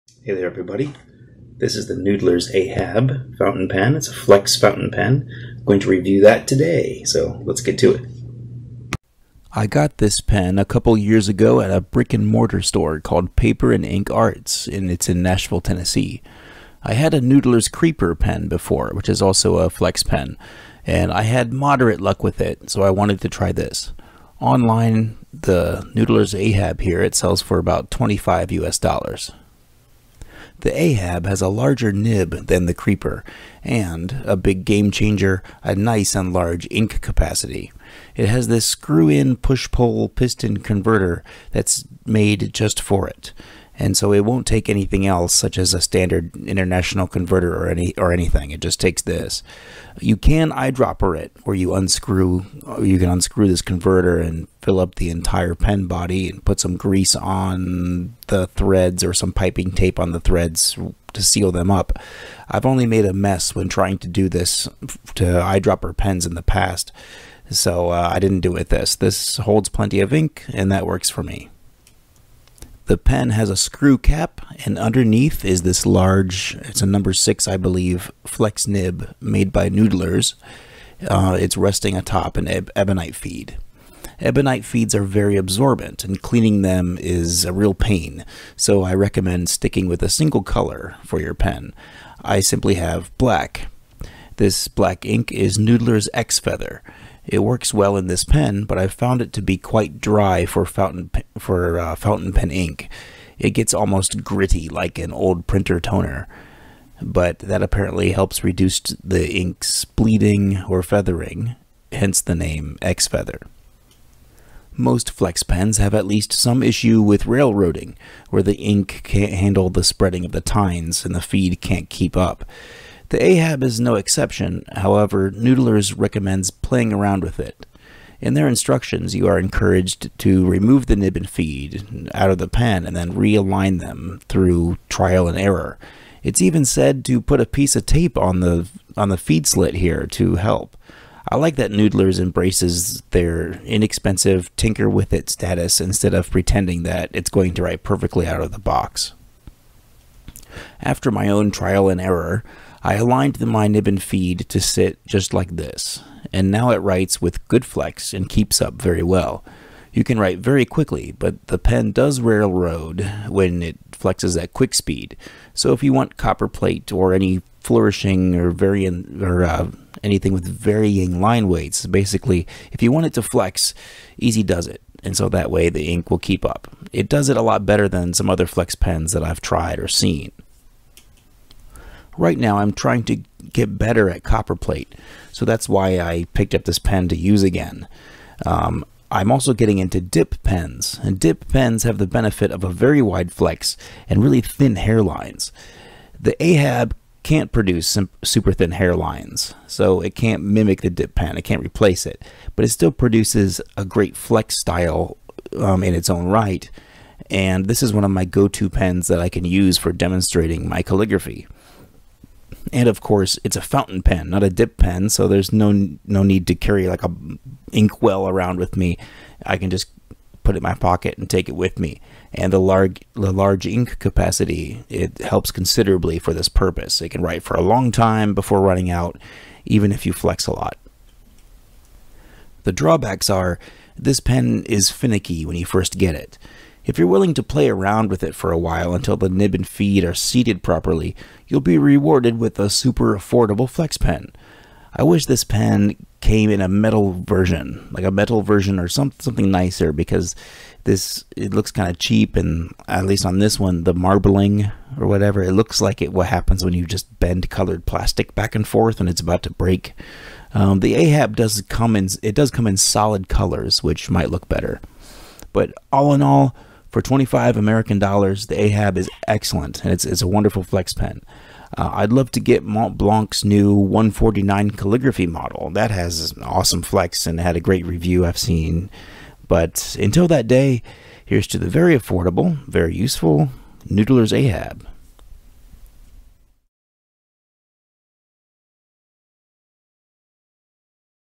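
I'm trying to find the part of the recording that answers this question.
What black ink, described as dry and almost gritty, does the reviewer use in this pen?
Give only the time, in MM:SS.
01:35.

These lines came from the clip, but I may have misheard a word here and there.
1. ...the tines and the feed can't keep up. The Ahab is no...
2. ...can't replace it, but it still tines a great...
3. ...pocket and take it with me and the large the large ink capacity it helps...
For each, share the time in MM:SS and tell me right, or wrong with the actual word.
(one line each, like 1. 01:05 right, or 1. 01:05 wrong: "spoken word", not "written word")
1. 02:00 right
2. 03:21 wrong: "produces", not "tines"
3. 03:40 right.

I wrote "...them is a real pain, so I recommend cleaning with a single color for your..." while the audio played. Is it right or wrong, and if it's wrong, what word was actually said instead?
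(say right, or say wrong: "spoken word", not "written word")
wrong: "sticking", not "cleaning".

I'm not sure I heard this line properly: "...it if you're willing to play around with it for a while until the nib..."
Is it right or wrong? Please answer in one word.
right.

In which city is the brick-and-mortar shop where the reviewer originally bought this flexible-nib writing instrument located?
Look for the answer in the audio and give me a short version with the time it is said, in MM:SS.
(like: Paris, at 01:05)
Nashville, Tennessee, at 00:15.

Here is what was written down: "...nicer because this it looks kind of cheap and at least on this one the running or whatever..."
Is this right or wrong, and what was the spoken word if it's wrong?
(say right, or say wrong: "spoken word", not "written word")
wrong: "marbling", not "running".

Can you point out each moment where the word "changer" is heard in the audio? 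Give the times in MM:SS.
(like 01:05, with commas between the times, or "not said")
00:34.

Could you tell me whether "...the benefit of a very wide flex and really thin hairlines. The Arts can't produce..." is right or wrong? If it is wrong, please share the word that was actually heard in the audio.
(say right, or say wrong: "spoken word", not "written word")
wrong: "Ahab", not "Arts".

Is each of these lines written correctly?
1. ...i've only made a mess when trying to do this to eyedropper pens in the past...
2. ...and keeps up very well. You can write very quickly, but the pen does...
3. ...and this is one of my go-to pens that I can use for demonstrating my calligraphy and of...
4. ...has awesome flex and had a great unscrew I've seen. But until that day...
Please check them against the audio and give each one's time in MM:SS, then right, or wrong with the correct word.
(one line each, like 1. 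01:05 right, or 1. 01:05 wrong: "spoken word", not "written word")
1. 01:02 right
2. 02:38 right
3. 03:27 right
4. 04:35 wrong: "review", not "unscrew".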